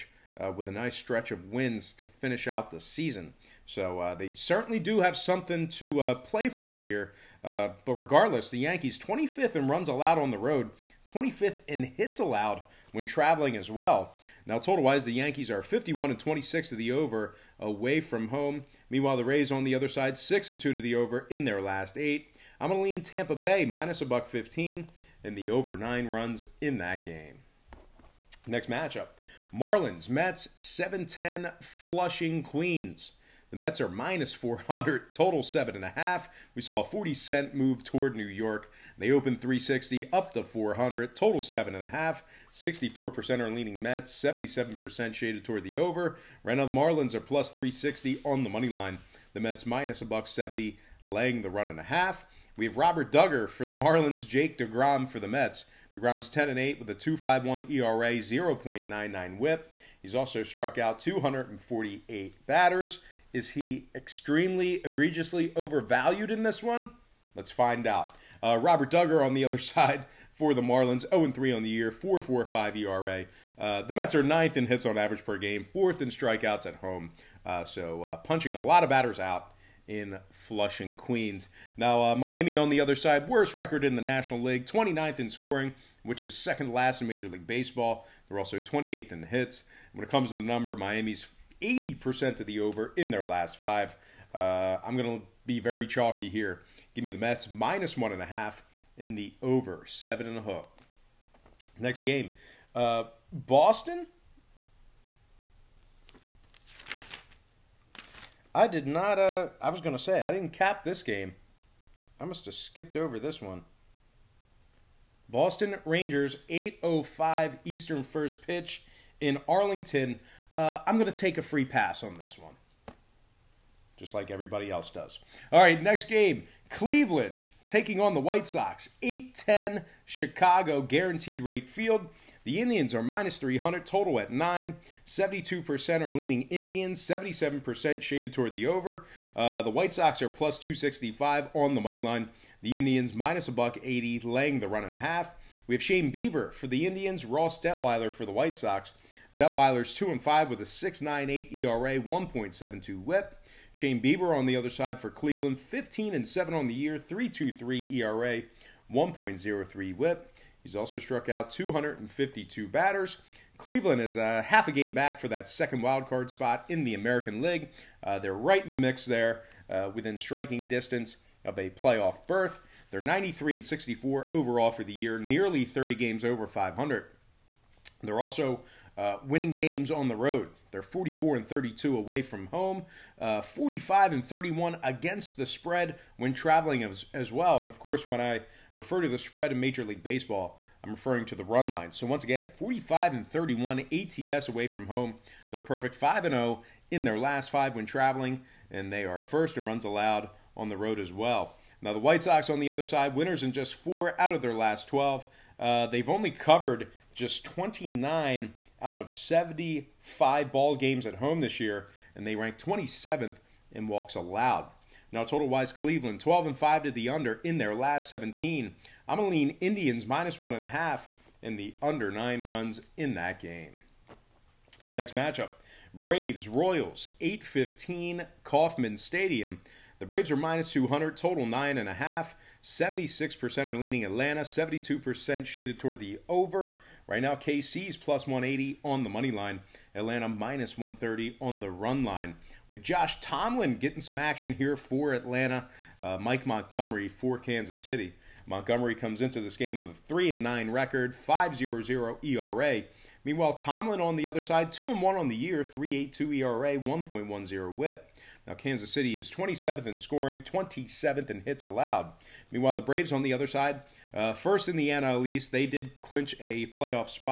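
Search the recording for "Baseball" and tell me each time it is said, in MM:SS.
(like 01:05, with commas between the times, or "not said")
01:27, 03:10.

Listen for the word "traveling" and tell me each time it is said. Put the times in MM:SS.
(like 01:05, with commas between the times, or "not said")
00:13, 03:06, 03:17.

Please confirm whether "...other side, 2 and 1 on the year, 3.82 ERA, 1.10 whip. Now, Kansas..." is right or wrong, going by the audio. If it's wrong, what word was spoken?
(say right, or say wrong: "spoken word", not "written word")
right.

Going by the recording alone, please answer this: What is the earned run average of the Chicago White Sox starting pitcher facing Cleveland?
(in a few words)
6.98.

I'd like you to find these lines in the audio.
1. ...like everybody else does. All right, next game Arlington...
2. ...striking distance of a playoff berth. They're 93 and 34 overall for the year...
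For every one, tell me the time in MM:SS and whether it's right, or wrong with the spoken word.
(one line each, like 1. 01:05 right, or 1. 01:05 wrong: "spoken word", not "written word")
1. 02:04 wrong: "Cleveland", not "Arlington"
2. 02:50 wrong: "64", not "34".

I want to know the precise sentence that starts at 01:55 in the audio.
Boston Rangers, 8.05 Eastern first pitch in Arlington.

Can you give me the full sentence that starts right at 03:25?
Uh, they've only covered just 29 out of 75 ball games at home this year, and they rank 27th in walks allowed.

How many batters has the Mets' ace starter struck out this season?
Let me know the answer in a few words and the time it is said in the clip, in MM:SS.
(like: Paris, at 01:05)
248, at 01:00.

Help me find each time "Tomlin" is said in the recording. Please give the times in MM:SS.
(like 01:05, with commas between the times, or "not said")
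04:03, 04:13.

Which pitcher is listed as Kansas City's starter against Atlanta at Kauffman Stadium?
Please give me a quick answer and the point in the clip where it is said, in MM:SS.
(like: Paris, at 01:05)
Mike Montgomery, at 04:06.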